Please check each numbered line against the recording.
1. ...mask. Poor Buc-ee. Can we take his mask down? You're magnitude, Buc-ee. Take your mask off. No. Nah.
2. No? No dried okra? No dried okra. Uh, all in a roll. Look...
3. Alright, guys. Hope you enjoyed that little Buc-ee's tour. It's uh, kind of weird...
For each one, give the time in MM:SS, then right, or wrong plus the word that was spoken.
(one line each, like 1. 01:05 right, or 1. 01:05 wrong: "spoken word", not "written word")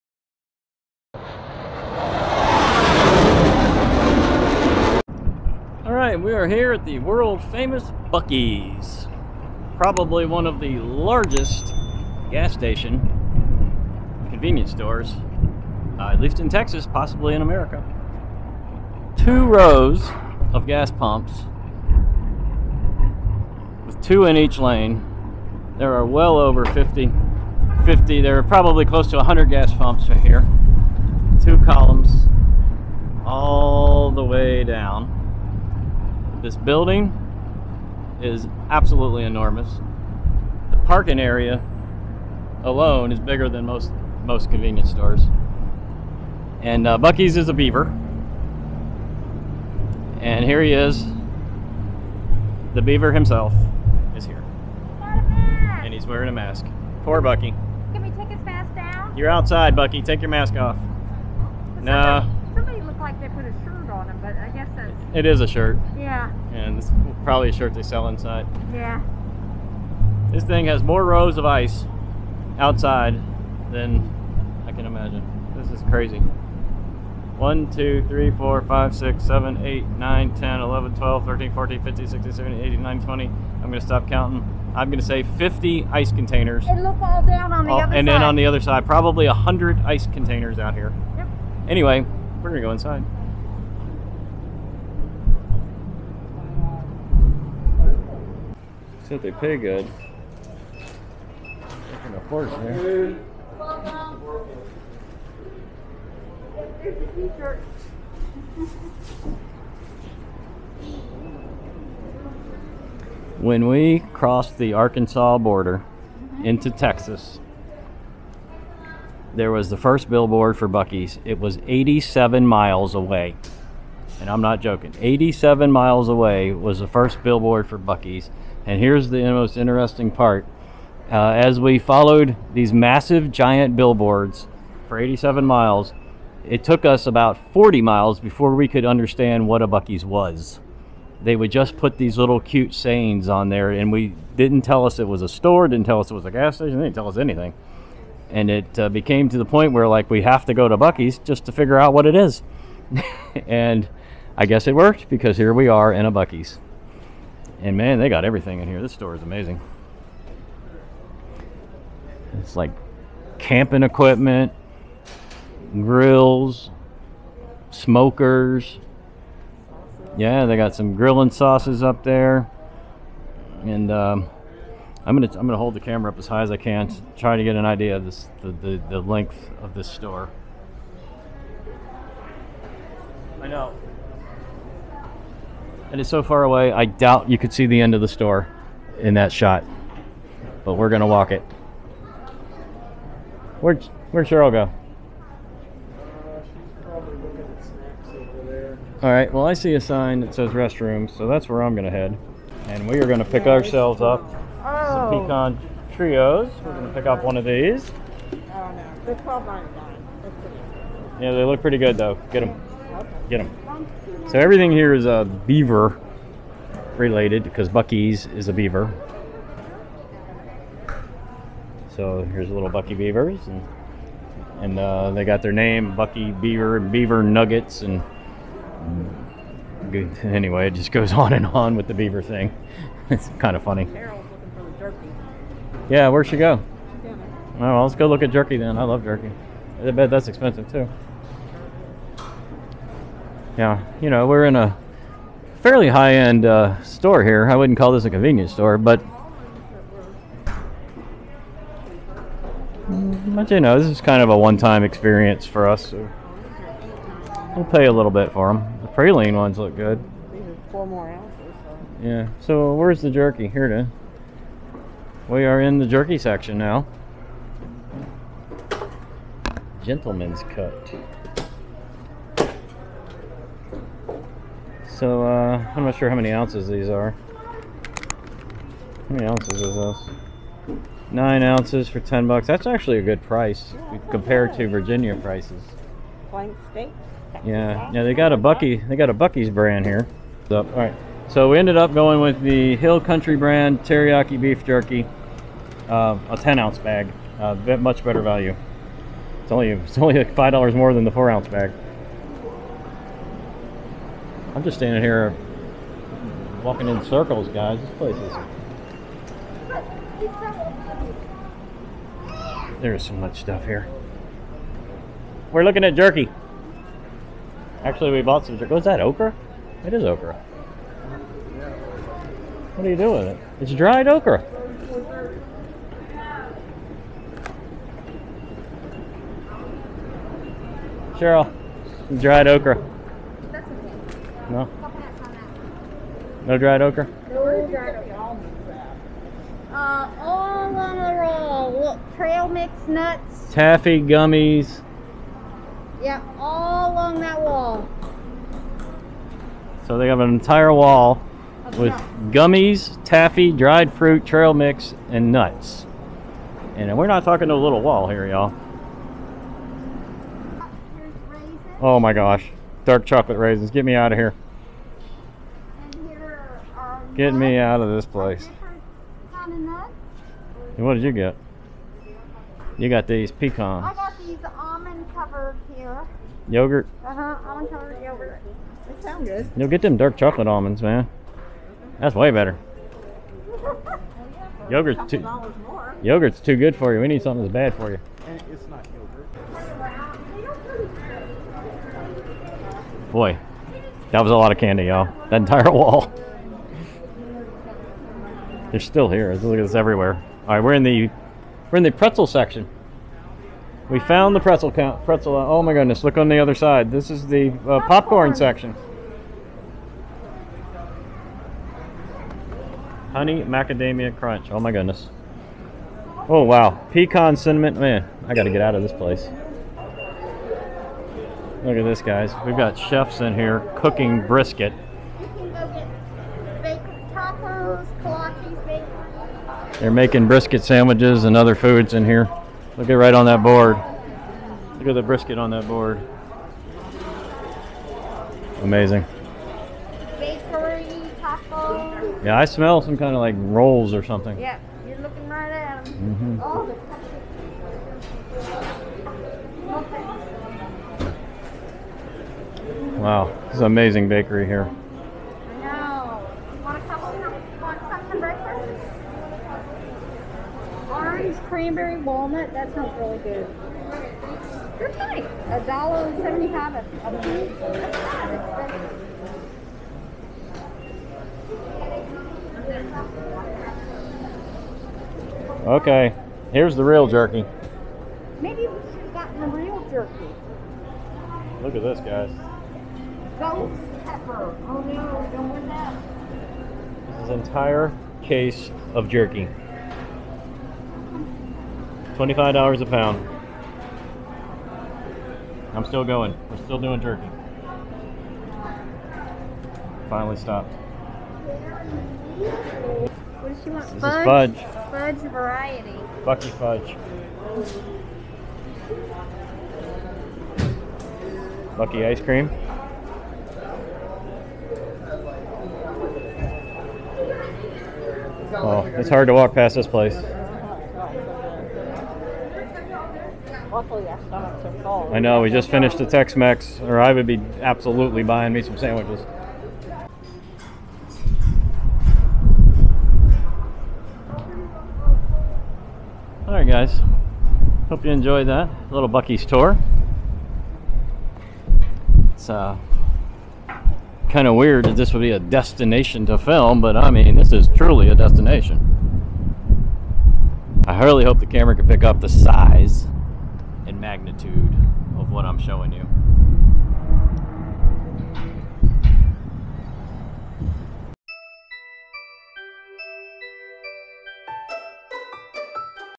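1. 00:56 wrong: "outside", not "magnitude"
2. 05:34 right
3. 08:56 right.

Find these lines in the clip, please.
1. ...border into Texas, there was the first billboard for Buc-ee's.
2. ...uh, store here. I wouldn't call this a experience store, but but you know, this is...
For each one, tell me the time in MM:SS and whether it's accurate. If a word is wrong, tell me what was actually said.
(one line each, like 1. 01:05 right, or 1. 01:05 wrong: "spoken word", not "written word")
1. 01:55 right
2. 04:06 wrong: "convenience", not "experience".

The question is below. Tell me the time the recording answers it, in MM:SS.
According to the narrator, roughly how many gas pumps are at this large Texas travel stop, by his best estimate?
00:28.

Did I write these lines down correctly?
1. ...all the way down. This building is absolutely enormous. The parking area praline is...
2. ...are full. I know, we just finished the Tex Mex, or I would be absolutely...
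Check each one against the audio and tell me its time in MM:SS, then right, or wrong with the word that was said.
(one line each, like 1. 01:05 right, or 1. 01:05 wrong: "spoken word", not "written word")
1. 00:33 wrong: "alone", not "praline"
2. 08:44 right.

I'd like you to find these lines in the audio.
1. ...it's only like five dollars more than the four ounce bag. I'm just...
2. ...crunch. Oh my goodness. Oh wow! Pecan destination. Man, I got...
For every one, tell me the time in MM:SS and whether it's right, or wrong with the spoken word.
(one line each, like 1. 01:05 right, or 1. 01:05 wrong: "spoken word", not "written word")
1. 04:59 right
2. 06:54 wrong: "cinnamon", not "destination".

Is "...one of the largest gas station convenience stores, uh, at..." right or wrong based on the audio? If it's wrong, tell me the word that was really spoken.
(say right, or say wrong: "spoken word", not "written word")
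right.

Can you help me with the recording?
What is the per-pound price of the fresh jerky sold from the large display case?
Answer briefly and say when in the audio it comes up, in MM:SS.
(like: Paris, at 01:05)
$25, at 08:12.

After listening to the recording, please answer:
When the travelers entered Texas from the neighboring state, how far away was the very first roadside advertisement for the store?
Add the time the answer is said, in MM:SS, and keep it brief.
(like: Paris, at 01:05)
87 miles, at 02:05.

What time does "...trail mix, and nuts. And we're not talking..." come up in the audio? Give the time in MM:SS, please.
05:54.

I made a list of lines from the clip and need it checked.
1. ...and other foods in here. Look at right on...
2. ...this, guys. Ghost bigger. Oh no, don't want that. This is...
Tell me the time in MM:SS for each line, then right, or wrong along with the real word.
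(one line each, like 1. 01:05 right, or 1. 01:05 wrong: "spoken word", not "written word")
1. 07:11 right
2. 08:01 wrong: "pepper", not "bigger".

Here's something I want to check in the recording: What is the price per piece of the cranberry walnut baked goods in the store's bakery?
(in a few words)
$1.75.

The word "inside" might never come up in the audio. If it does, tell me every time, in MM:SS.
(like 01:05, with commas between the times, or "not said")
01:08, 01:32.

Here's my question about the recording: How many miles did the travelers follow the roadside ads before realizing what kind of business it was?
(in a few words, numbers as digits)
about 40 miles.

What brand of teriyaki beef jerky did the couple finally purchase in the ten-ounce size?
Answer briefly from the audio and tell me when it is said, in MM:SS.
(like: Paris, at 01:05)
Hill Country, at 04:52.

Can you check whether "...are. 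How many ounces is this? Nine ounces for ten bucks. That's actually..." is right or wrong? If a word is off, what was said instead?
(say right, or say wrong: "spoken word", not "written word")
right.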